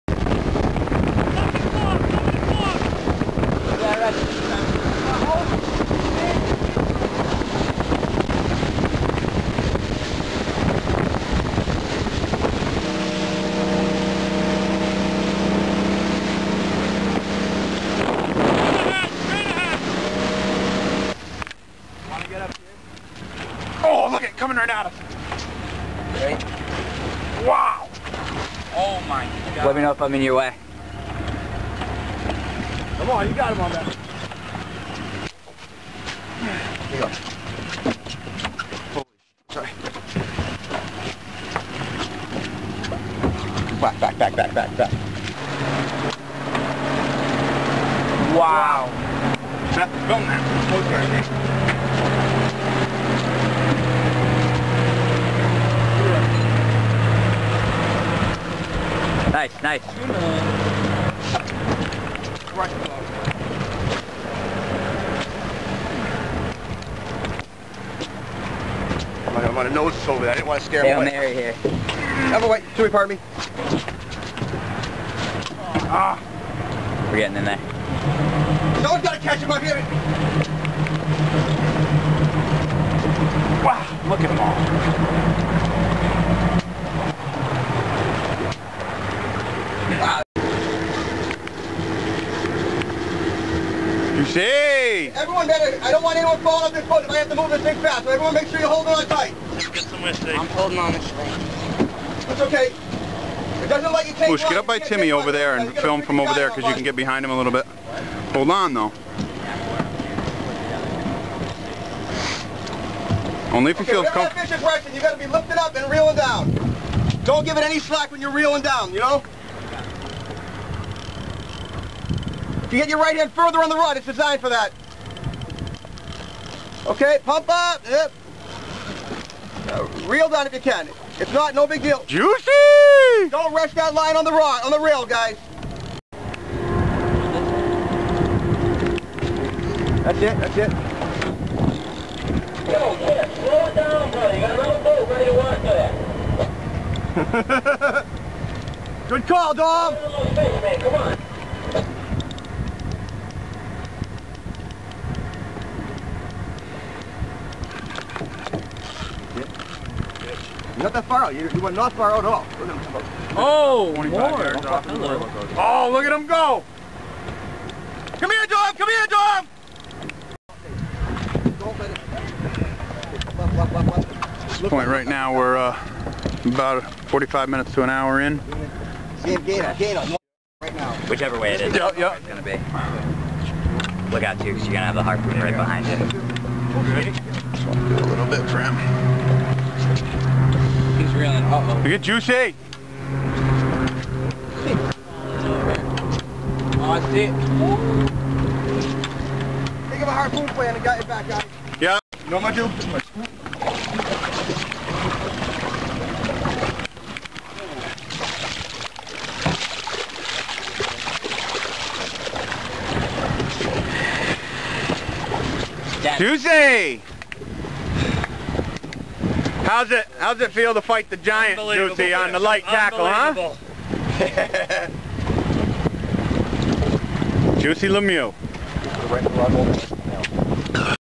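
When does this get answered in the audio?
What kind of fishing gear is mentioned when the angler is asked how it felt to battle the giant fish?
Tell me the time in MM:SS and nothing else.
03:42.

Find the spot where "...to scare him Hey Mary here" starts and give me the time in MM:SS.
01:10.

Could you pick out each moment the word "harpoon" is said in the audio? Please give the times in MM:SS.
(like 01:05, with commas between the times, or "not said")
03:05, 03:20.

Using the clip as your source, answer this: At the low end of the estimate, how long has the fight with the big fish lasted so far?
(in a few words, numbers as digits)
45 minutes.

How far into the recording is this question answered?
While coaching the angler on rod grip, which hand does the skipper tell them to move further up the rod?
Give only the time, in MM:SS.
02:02.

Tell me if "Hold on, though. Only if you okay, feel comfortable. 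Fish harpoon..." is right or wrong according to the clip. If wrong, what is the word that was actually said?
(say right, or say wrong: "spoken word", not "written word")
wrong: "impression", not "harpoon".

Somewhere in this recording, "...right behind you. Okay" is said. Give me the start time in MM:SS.
03:05.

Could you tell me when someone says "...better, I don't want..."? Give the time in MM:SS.
01:35.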